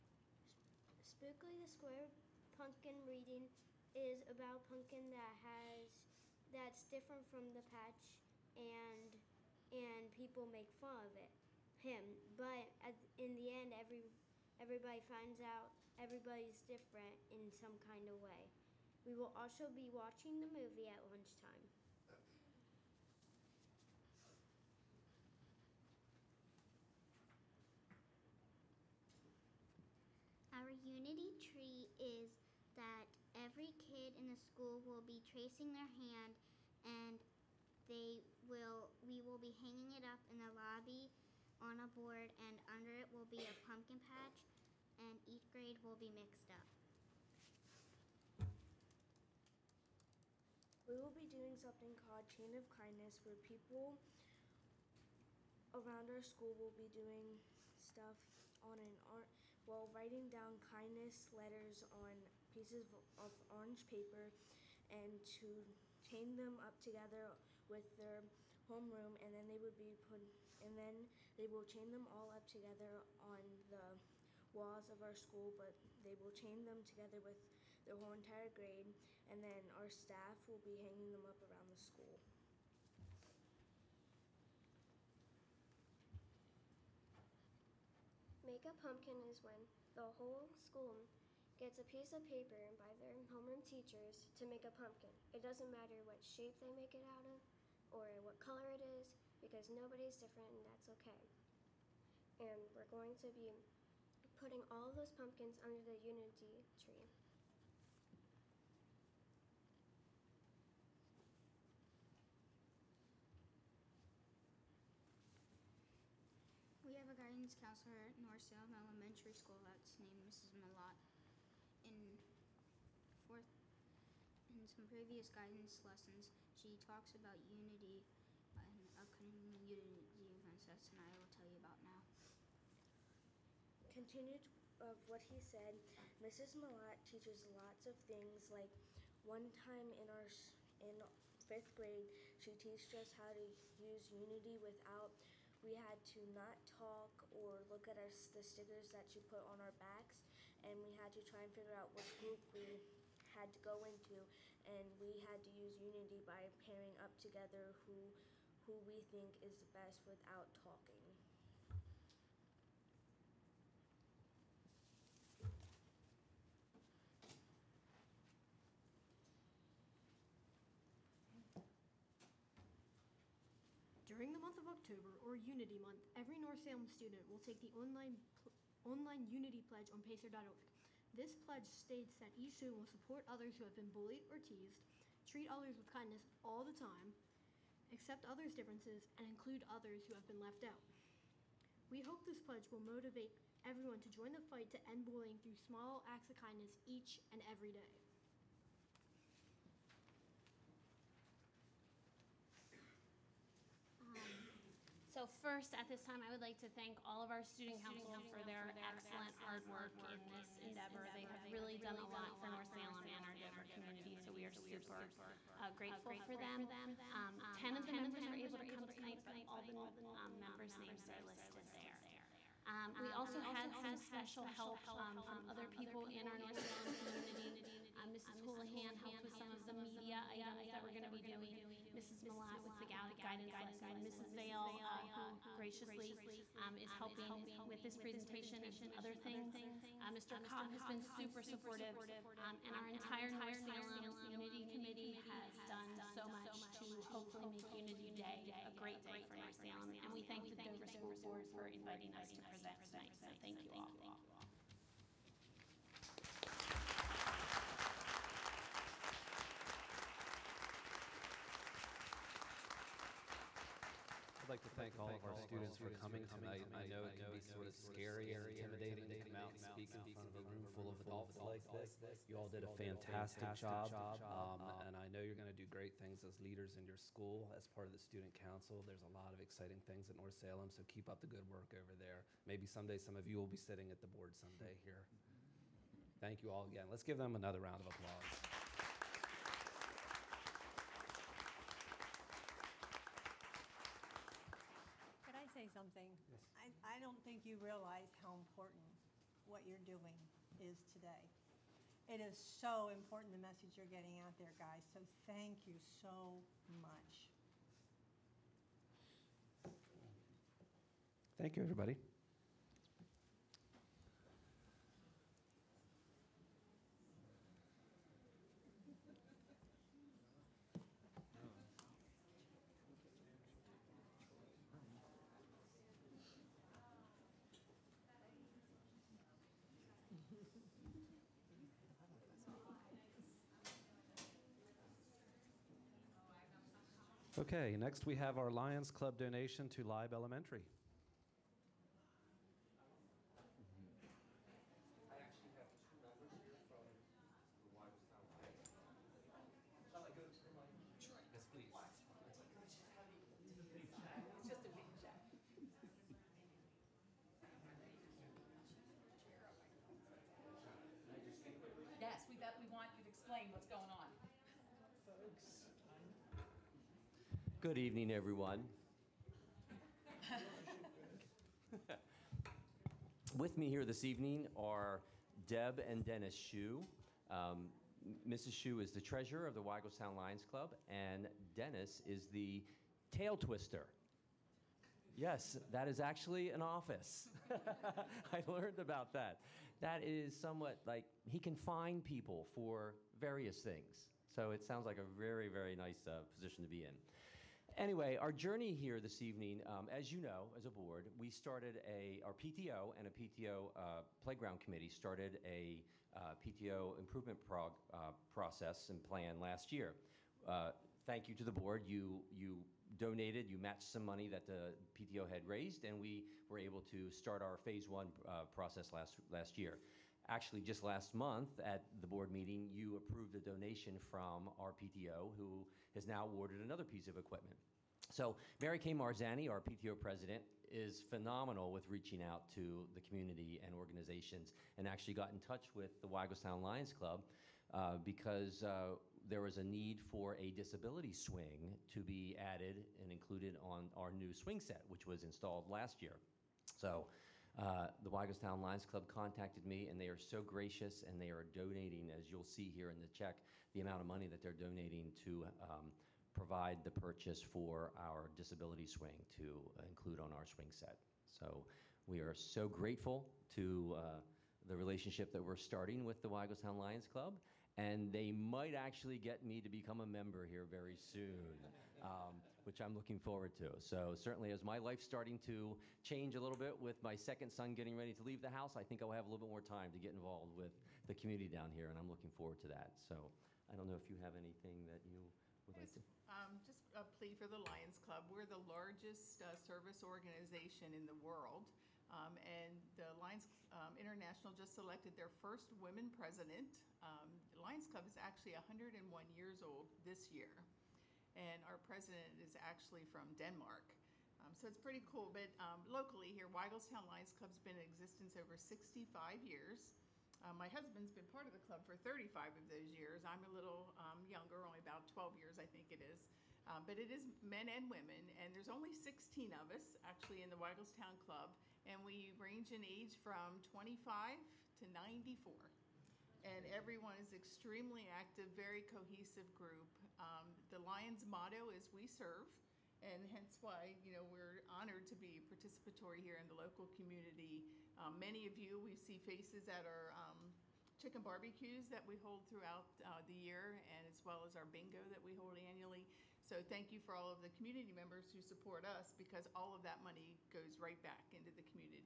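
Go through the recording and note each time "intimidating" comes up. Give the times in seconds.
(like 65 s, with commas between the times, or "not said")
268 s.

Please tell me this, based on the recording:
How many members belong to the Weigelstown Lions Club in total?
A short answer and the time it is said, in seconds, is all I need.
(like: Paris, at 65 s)
16, at 518 s.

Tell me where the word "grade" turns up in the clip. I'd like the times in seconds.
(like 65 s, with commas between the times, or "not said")
45 s, 78 s, 141 s.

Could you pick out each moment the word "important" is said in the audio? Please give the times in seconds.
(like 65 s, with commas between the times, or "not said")
298 s, 302 s.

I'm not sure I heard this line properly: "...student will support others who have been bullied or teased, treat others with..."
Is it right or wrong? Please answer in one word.
right.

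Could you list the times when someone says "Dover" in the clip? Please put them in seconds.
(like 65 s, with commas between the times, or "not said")
213 s, 250 s.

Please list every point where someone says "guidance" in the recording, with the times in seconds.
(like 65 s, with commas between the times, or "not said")
117 s, 125 s, 232 s.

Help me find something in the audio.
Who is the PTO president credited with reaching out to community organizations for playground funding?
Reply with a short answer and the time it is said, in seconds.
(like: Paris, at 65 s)
Mary Kay Marzani, at 428 s.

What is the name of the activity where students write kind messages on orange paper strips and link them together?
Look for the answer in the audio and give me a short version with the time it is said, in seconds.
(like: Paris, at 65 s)
Chain of Kindness, at 52 s.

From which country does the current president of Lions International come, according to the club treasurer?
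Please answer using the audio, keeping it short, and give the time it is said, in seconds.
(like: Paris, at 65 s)
Denmark, at 503 s.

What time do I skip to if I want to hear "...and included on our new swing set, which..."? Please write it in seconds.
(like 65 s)
443 s.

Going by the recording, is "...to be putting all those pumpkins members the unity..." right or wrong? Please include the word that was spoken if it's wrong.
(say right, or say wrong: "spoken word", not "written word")
wrong: "under", not "members".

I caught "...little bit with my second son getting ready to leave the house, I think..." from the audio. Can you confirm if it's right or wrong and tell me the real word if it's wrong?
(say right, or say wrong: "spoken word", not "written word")
right.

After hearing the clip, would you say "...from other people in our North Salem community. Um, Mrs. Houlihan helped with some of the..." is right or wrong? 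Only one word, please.
right.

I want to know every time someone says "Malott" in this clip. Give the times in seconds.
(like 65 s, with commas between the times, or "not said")
120 s, 136 s, 232 s.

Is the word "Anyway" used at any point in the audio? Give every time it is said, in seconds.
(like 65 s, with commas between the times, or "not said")
397 s.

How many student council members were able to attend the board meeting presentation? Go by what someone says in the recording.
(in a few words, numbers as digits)
10.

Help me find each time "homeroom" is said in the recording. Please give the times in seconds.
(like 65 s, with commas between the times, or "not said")
68 s, 93 s.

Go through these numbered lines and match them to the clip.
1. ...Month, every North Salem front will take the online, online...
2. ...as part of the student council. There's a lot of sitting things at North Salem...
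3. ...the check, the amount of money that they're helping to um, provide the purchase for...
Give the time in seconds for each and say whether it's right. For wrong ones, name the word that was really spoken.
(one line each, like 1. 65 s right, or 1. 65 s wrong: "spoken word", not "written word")
1. 175 s wrong: "student", not "front"
2. 277 s wrong: "exciting", not "sitting"
3. 453 s wrong: "donating", not "helping".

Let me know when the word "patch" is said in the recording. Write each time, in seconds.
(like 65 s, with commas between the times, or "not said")
7 s, 44 s.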